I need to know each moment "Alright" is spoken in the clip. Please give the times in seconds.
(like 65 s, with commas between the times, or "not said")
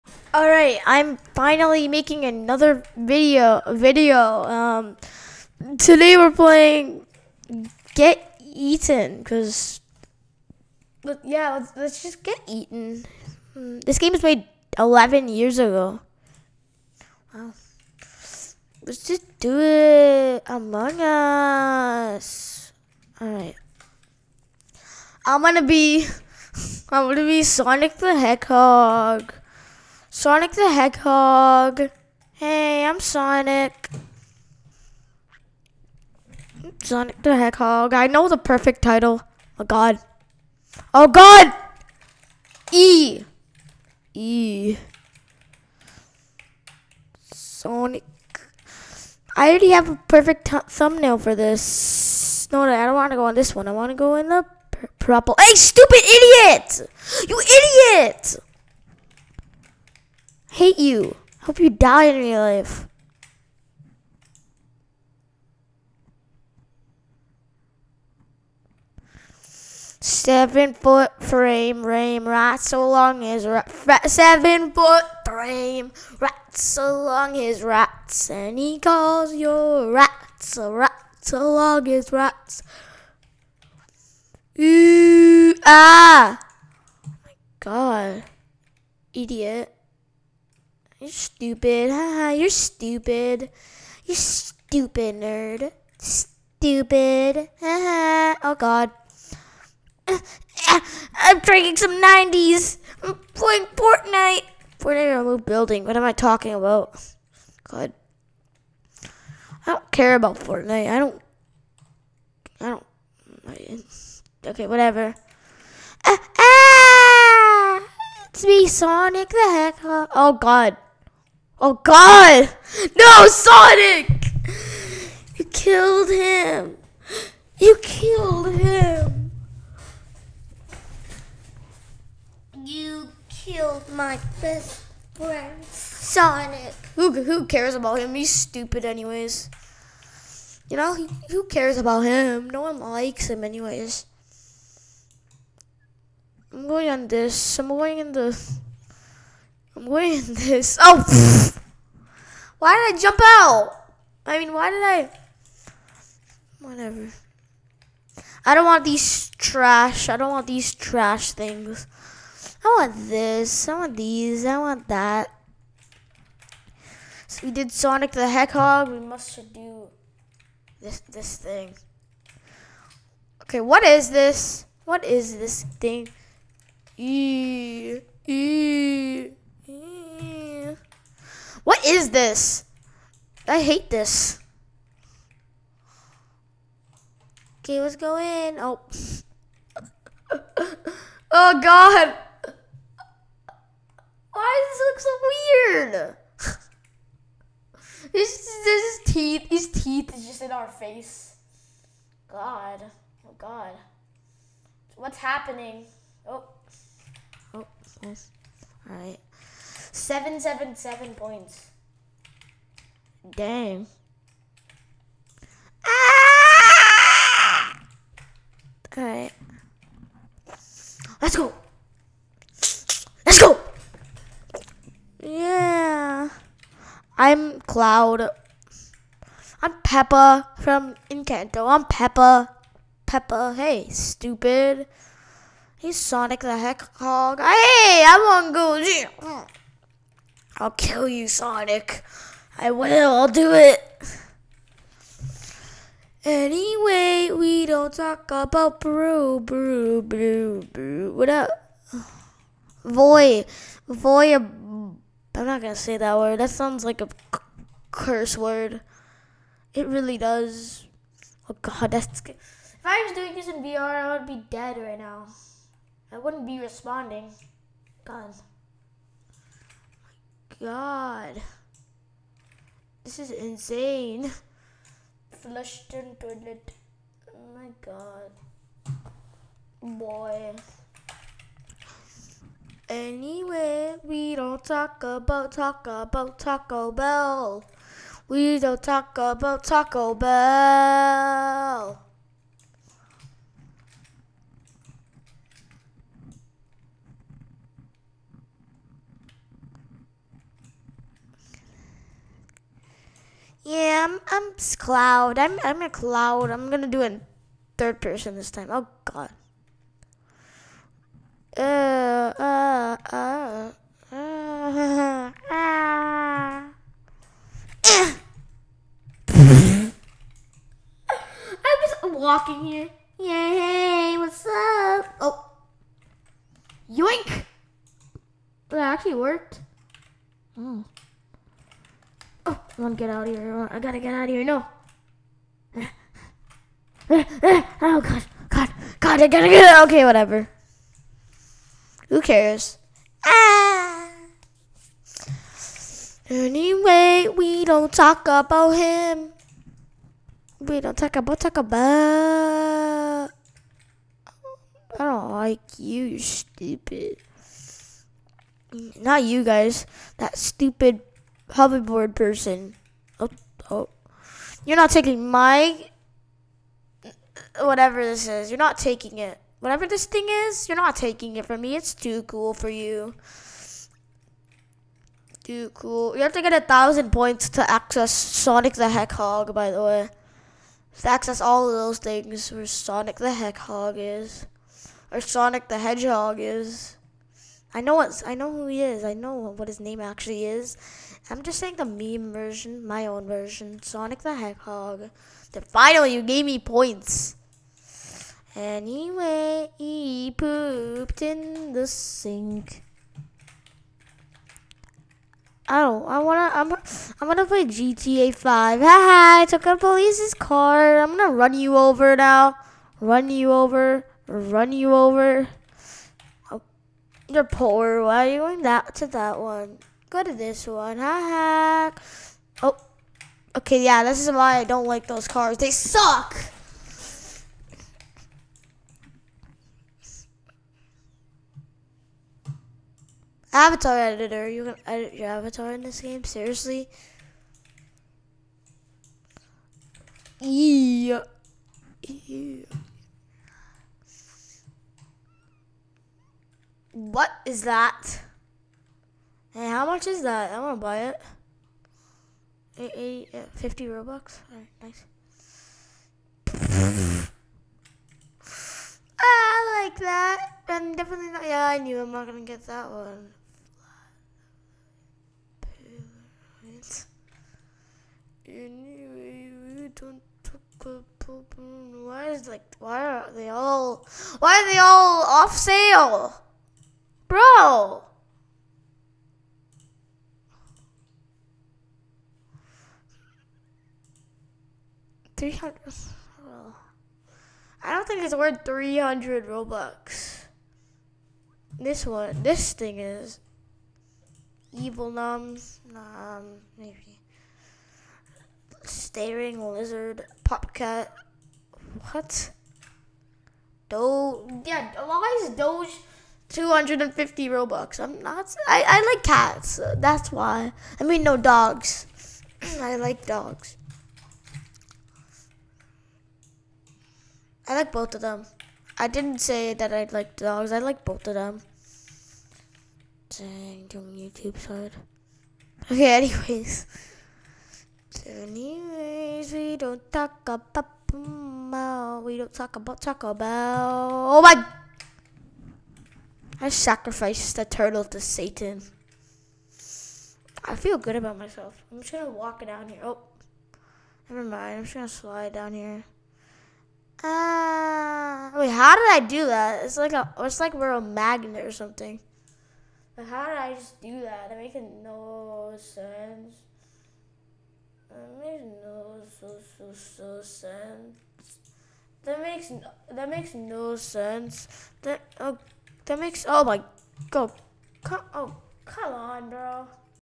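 0 s, 23 s, 454 s.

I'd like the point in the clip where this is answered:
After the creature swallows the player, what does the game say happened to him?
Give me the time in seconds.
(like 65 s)
275 s.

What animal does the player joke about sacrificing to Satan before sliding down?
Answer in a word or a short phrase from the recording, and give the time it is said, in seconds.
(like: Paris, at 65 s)
turtle, at 537 s.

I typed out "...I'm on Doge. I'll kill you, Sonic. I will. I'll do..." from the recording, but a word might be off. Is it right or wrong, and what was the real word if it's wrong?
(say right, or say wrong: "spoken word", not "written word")
wrong: "Gold", not "Doge".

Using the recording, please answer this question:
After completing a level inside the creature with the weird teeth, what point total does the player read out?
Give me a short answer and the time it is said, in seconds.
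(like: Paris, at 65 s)
777, at 209 s.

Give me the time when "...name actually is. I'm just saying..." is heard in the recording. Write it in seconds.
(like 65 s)
389 s.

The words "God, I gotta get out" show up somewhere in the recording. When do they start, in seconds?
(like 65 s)
338 s.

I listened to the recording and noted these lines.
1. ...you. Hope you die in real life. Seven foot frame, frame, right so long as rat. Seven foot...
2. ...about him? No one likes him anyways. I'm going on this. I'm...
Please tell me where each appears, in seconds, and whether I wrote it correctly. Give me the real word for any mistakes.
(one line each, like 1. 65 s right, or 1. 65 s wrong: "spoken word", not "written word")
1. 60 s right
2. 141 s right.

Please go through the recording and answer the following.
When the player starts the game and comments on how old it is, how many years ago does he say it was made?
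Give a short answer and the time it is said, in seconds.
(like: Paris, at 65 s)
11, at 14 s.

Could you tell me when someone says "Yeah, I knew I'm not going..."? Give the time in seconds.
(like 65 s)
461 s.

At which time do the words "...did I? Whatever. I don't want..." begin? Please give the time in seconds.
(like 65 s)
154 s.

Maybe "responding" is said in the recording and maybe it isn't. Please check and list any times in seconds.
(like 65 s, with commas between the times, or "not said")
266 s.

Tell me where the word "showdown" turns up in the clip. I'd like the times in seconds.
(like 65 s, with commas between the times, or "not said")
not said.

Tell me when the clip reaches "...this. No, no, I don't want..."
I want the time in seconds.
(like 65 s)
51 s.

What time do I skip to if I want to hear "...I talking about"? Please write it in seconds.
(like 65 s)
106 s.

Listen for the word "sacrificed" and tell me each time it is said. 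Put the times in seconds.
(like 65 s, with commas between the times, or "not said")
536 s.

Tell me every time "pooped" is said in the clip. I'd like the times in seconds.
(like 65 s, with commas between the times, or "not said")
400 s.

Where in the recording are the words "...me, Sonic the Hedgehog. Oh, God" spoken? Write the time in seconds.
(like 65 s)
118 s.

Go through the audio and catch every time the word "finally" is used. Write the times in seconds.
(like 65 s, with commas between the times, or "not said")
1 s, 395 s.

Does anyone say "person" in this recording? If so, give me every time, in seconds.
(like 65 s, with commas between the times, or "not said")
308 s, 362 s.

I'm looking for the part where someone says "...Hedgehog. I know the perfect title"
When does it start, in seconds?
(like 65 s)
37 s.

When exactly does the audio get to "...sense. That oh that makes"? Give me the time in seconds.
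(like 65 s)
563 s.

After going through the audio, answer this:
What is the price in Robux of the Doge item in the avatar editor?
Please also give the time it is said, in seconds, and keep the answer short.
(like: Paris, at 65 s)
250, at 506 s.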